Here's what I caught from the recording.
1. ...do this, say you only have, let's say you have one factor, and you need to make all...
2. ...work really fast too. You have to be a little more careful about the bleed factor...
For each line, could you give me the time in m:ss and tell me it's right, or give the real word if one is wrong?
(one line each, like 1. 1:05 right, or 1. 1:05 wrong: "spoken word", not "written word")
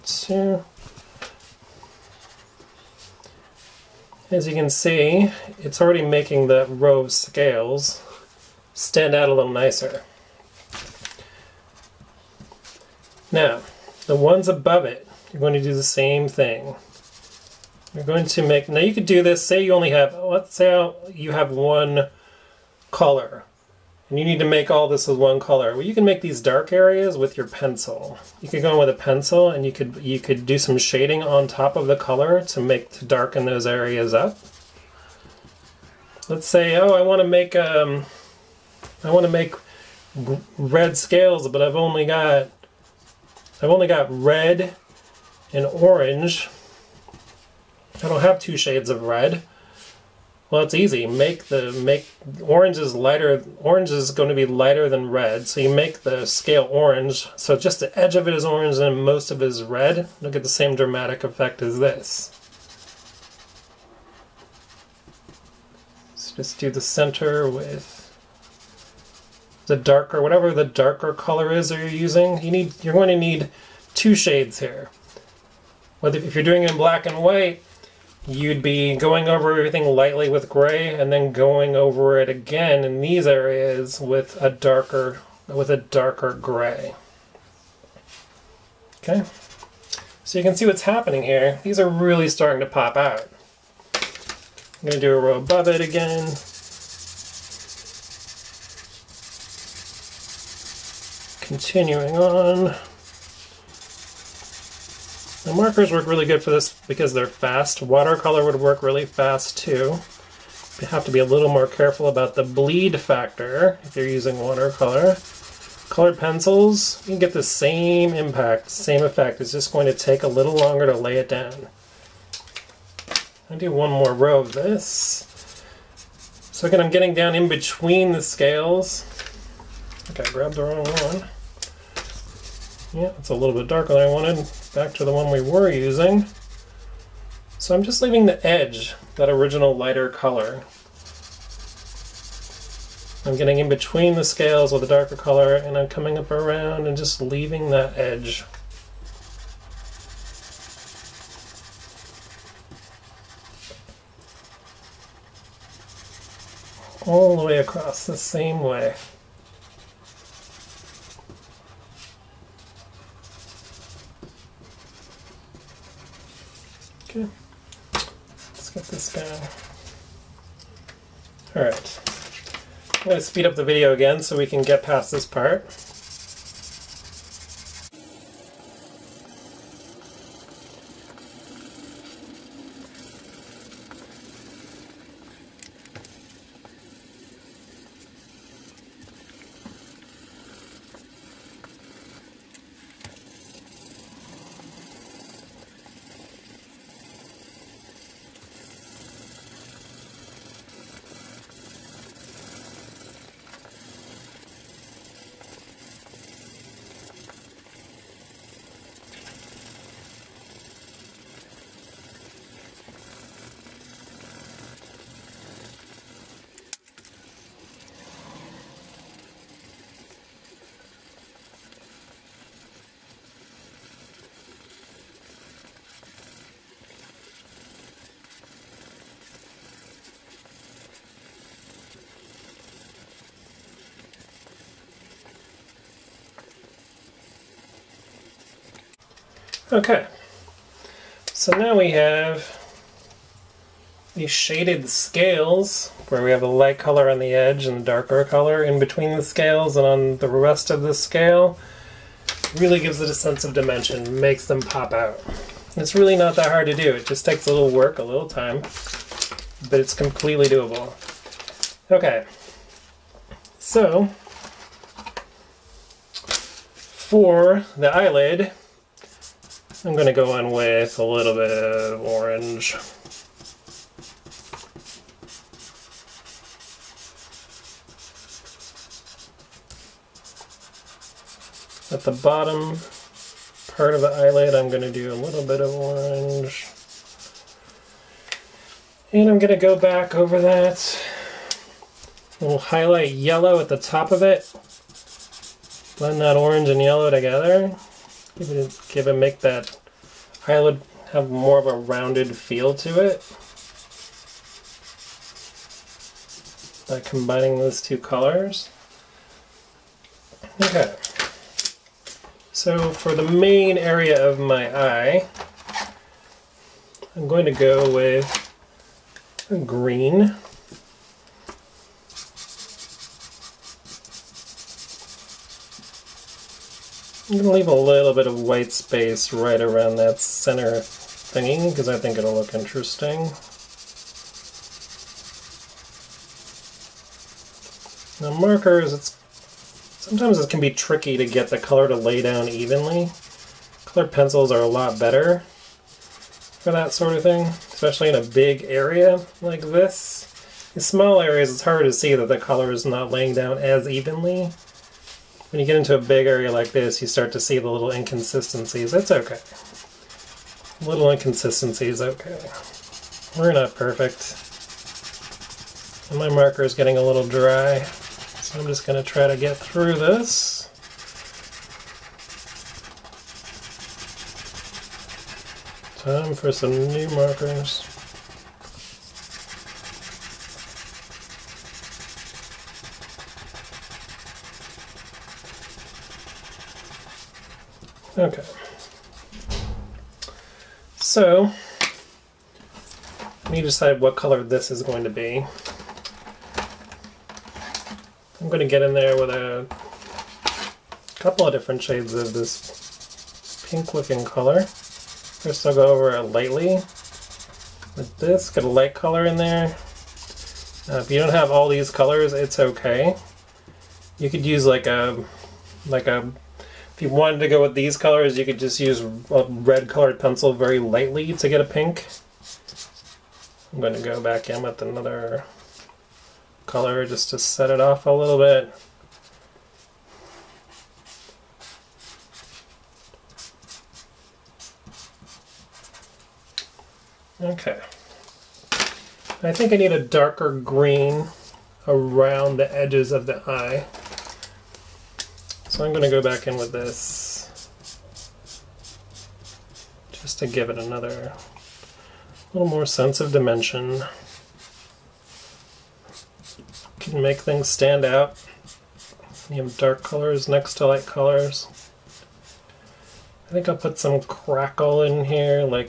1. 0:19 wrong: "color", not "factor"
2. 1:48 right.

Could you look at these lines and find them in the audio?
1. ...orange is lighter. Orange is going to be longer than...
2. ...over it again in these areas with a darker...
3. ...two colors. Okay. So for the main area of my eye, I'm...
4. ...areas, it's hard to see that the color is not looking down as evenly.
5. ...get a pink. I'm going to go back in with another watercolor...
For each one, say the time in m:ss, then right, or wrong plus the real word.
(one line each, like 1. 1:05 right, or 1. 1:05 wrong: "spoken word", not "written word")
1. 0:52 wrong: "lighter", not "longer"
2. 1:21 right
3. 5:07 right
4. 5:51 wrong: "laying", not "looking"
5. 7:01 wrong: "color", not "watercolor".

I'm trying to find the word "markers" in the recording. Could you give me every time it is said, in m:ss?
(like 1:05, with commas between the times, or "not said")
1:45, 5:38, 6:06, 6:17.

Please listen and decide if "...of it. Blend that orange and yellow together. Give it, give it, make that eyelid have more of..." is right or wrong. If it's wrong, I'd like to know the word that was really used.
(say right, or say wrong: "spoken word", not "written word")
right.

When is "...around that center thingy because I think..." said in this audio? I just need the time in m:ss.
5:29.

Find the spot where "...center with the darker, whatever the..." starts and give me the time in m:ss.
1:06.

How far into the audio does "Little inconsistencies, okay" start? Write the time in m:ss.
6:00.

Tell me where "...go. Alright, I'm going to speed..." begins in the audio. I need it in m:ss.
2:49.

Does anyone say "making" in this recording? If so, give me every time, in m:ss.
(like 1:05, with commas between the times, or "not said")
0:06.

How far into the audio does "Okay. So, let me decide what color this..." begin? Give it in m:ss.
6:28.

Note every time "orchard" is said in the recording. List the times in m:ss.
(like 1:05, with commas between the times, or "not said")
not said.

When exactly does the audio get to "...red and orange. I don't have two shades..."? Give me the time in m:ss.
0:44.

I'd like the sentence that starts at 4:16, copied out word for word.
It just takes a little work, a little time, but it's completely doable.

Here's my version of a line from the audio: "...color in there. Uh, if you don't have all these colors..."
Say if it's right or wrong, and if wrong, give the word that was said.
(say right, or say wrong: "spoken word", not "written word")
right.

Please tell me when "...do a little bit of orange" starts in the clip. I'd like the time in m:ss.
4:44.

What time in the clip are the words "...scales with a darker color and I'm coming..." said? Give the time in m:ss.
2:24.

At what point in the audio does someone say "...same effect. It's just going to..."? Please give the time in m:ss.
1:58.